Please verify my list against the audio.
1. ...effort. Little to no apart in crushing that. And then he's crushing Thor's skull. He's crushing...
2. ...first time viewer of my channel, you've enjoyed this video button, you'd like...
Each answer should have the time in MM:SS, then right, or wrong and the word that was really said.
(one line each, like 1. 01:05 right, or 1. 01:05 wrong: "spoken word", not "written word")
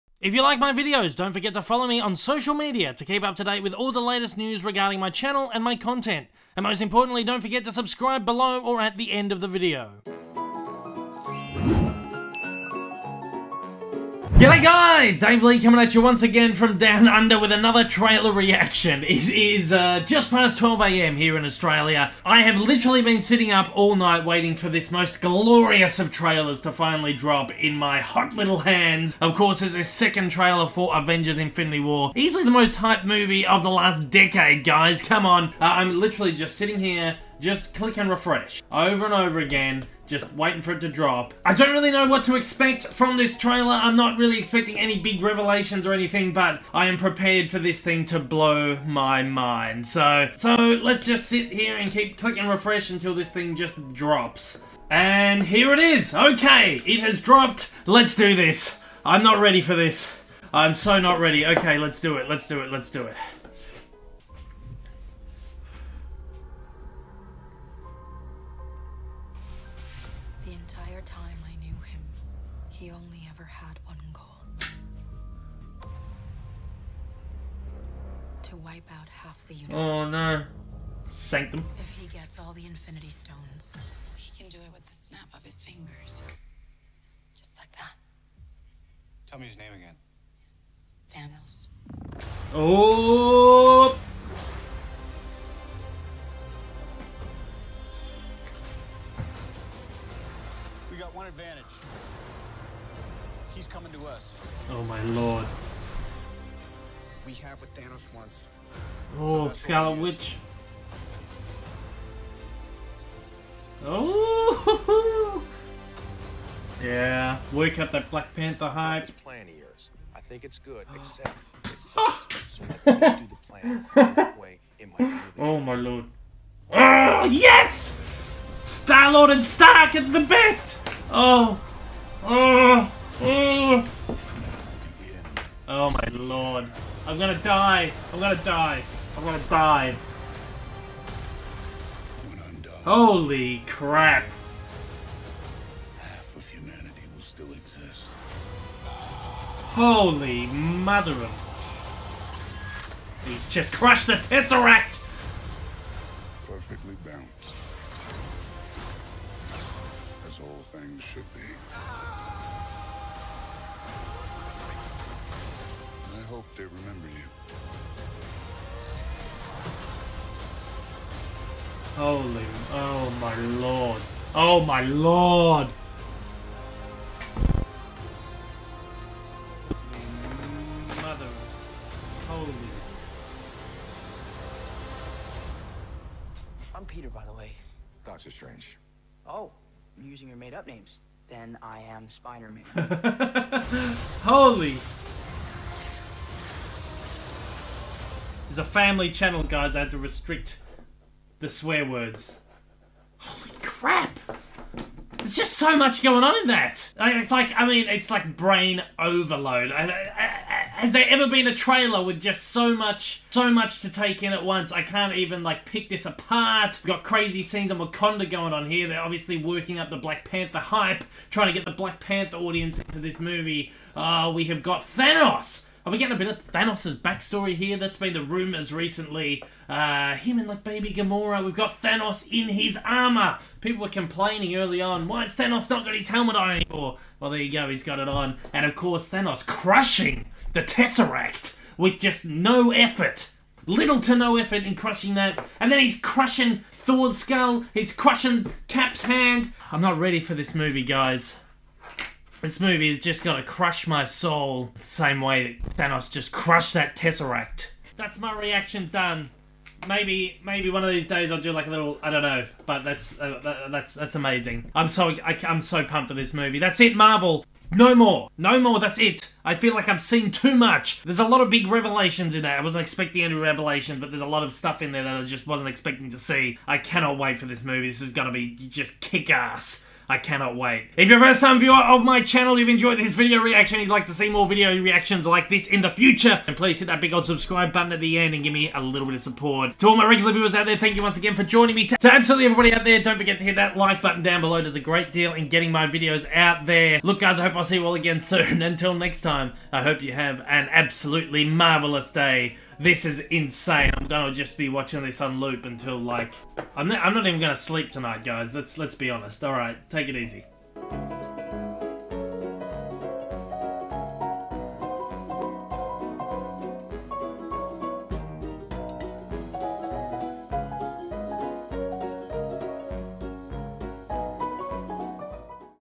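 1. 04:02 wrong: "effort", not "apart"
2. 04:41 wrong: "reaction", not "button".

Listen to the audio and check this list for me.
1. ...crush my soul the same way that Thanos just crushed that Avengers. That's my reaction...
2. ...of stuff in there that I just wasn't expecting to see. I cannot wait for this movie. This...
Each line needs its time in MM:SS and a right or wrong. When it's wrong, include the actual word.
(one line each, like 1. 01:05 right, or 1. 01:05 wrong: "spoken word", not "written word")
1. 04:13 wrong: "Tesseract", not "Avengers"
2. 04:34 right.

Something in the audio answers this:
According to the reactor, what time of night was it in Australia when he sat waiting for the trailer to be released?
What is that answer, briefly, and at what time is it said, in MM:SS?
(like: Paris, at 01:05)
12am, at 00:20.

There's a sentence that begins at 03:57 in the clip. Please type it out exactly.
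Well, there you go, he's got it on.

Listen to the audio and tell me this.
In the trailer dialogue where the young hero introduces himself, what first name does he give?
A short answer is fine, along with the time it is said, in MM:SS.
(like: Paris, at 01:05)
Peter, at 03:06.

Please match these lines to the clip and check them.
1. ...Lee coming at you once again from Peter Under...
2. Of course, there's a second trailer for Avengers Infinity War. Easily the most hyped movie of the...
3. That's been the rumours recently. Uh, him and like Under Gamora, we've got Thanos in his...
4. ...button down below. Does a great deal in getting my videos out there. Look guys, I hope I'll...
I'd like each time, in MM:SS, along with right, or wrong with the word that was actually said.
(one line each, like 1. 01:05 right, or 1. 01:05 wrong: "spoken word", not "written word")
1. 00:15 wrong: "Down", not "Peter"
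2. 00:29 right
3. 03:47 wrong: "Baby", not "Under"
4. 04:54 right.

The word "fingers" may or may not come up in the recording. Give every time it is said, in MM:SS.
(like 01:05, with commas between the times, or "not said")
01:25.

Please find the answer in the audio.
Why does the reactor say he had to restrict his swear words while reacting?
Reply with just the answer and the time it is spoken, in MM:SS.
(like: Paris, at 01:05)
Family channel, at 03:18.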